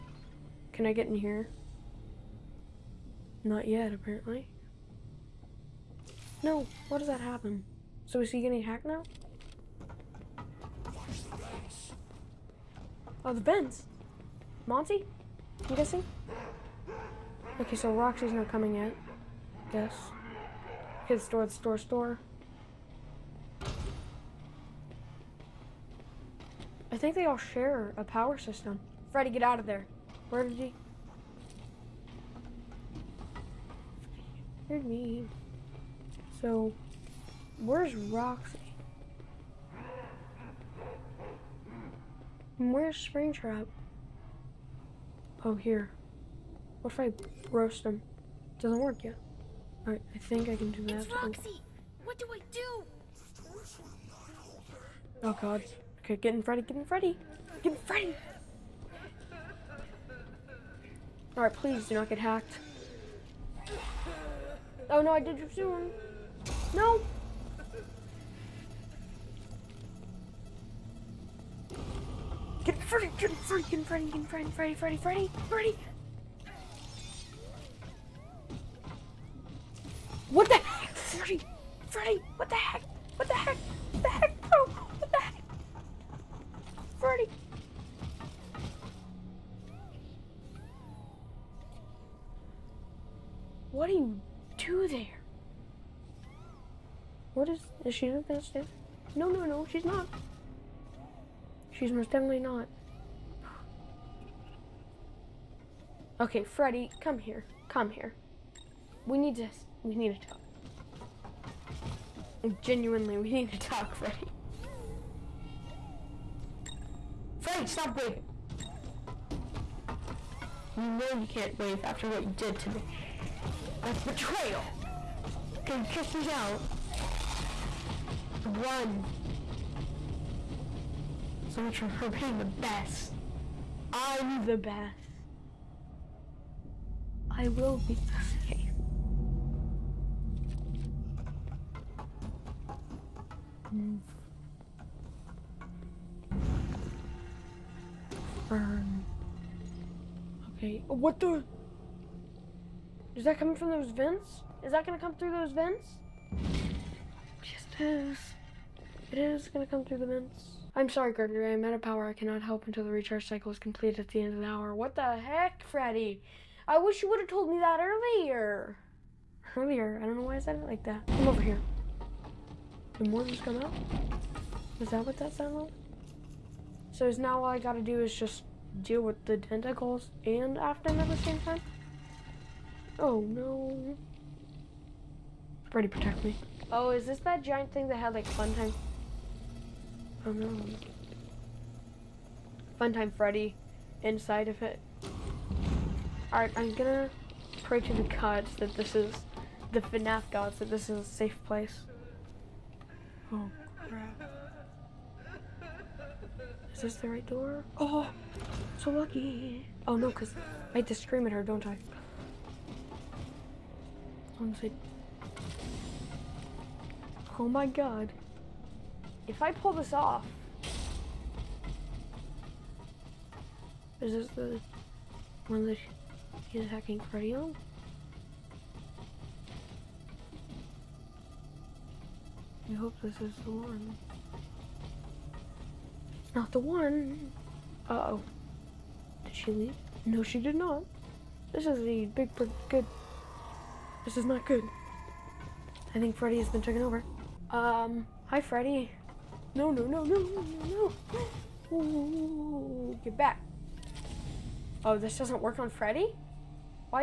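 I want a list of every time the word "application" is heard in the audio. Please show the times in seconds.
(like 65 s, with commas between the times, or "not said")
not said.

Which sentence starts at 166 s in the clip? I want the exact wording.
I wish you would have told me that earlier.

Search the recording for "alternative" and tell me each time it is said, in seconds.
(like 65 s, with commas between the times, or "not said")
not said.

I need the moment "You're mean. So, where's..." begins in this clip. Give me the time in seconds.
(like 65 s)
34 s.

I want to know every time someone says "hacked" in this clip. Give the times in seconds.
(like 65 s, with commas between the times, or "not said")
8 s, 62 s.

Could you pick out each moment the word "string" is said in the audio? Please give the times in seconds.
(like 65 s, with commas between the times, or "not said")
not said.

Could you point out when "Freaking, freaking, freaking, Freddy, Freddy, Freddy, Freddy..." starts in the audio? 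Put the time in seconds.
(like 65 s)
73 s.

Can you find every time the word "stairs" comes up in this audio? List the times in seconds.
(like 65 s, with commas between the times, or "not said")
98 s.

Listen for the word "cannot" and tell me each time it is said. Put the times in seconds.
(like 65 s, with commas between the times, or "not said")
162 s.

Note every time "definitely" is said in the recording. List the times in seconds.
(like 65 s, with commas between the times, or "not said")
102 s.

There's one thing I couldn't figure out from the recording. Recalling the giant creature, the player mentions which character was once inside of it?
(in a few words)
Fun time Freddy.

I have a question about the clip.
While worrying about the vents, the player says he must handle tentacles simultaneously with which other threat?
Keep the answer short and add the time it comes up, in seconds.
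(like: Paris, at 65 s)
Aftermath, at 180 s.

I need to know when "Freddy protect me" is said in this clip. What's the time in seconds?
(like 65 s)
185 s.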